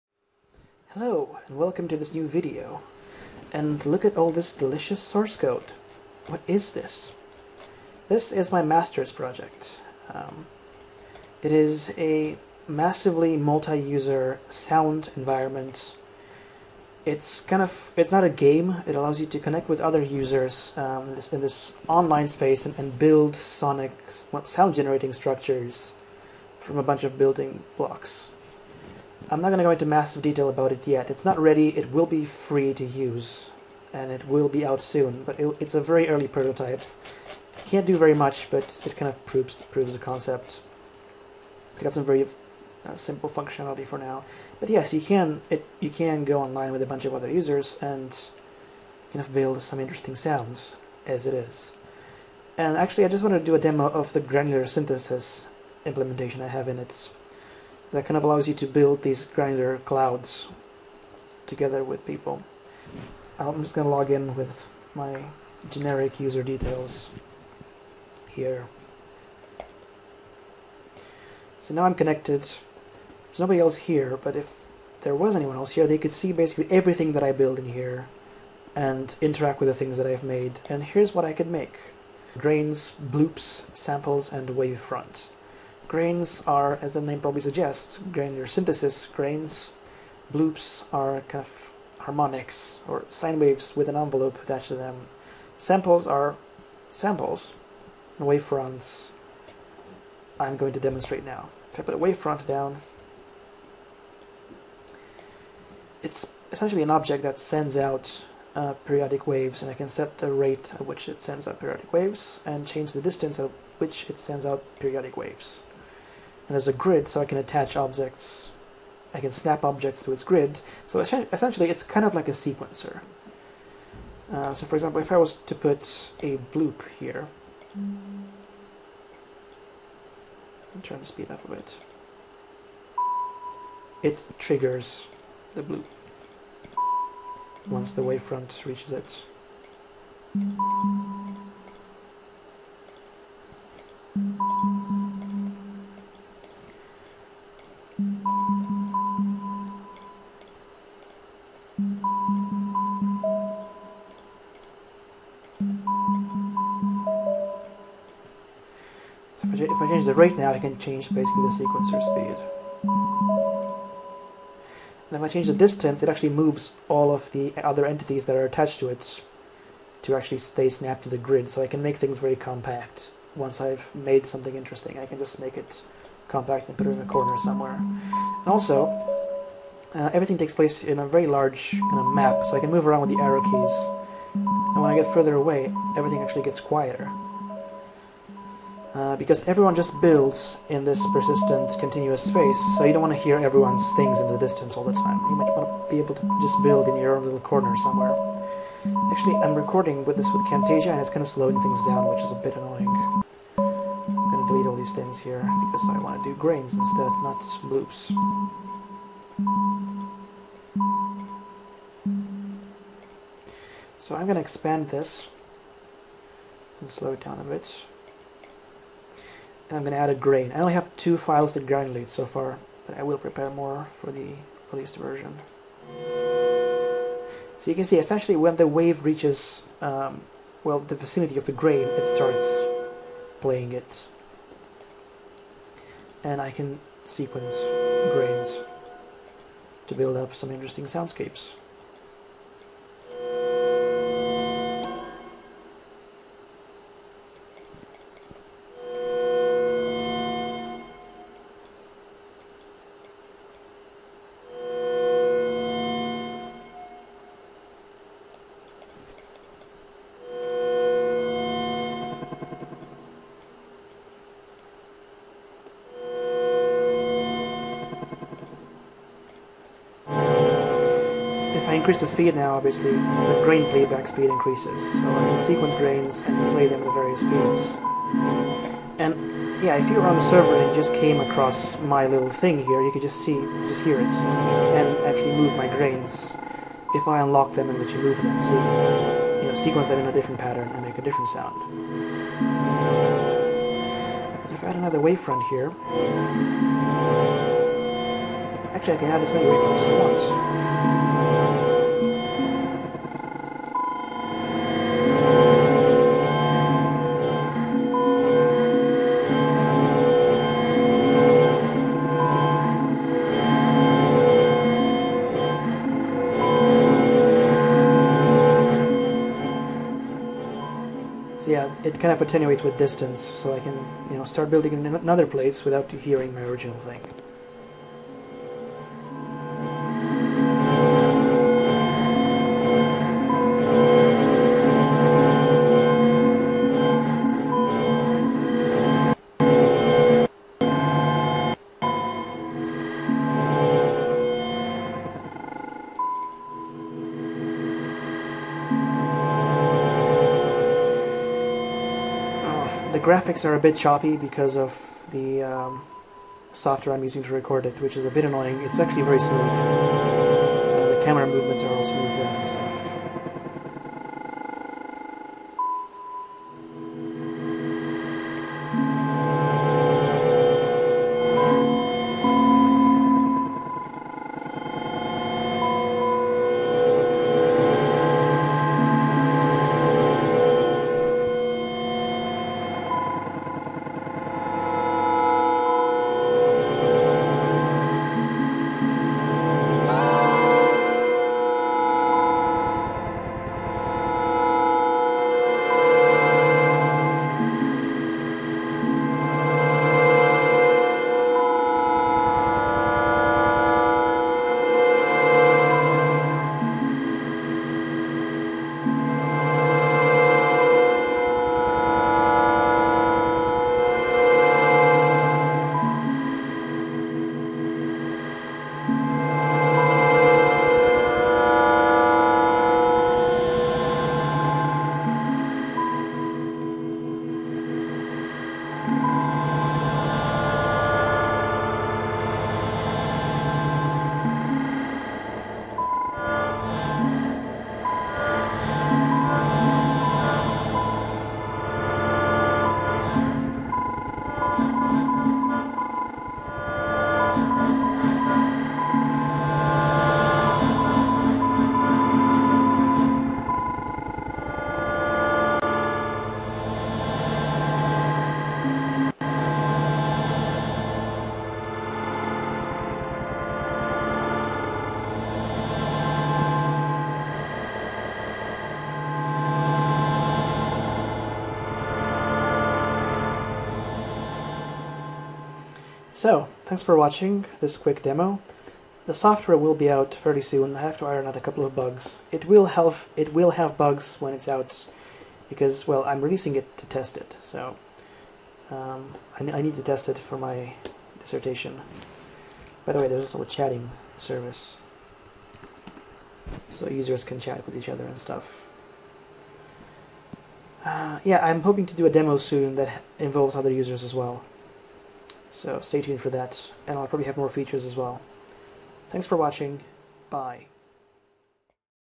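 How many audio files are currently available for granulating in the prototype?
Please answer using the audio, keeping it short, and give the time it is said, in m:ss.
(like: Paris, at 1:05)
2, at 3:40.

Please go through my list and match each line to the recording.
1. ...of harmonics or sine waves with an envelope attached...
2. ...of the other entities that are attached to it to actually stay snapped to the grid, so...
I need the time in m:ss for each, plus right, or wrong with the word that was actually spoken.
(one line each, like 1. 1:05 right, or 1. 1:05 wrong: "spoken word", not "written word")
1. 1:31 right
2. 2:47 right.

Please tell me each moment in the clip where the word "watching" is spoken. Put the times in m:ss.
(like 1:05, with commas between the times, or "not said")
7:56, 8:29.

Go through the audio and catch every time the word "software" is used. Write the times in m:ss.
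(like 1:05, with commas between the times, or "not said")
5:56, 7:59.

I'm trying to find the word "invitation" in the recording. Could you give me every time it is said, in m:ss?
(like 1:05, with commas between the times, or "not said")
not said.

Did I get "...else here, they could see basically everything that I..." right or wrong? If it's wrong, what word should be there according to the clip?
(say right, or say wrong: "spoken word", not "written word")
right.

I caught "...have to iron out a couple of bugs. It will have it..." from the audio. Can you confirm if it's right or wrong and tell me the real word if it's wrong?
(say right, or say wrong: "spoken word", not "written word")
right.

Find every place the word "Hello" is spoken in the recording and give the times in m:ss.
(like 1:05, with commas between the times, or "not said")
0:00.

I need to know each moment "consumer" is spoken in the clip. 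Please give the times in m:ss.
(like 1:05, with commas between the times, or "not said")
not said.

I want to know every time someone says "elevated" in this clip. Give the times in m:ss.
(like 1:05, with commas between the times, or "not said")
not said.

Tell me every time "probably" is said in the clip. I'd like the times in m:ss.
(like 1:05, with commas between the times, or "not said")
1:27, 8:27.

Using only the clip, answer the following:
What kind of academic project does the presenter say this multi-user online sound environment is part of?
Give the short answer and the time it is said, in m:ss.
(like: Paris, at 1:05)
Master's project, at 0:08.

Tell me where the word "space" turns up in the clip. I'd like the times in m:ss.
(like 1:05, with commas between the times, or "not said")
0:22, 3:12.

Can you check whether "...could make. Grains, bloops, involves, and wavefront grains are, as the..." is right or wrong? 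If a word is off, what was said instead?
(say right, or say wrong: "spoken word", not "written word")
wrong: "samples", not "involves".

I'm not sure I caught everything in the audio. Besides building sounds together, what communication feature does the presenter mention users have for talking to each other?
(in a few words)
A chatting service.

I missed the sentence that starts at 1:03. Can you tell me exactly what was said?
I'm just going to log in with my generic user details here.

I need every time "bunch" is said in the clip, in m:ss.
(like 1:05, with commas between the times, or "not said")
0:26, 0:46.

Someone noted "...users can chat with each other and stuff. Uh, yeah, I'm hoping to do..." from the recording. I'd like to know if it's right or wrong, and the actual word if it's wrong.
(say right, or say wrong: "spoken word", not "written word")
right.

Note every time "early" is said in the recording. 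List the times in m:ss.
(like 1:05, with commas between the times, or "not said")
0:36.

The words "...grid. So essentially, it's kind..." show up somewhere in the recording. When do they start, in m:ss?
2:00.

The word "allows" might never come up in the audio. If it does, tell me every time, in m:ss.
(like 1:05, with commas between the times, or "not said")
0:18, 0:58.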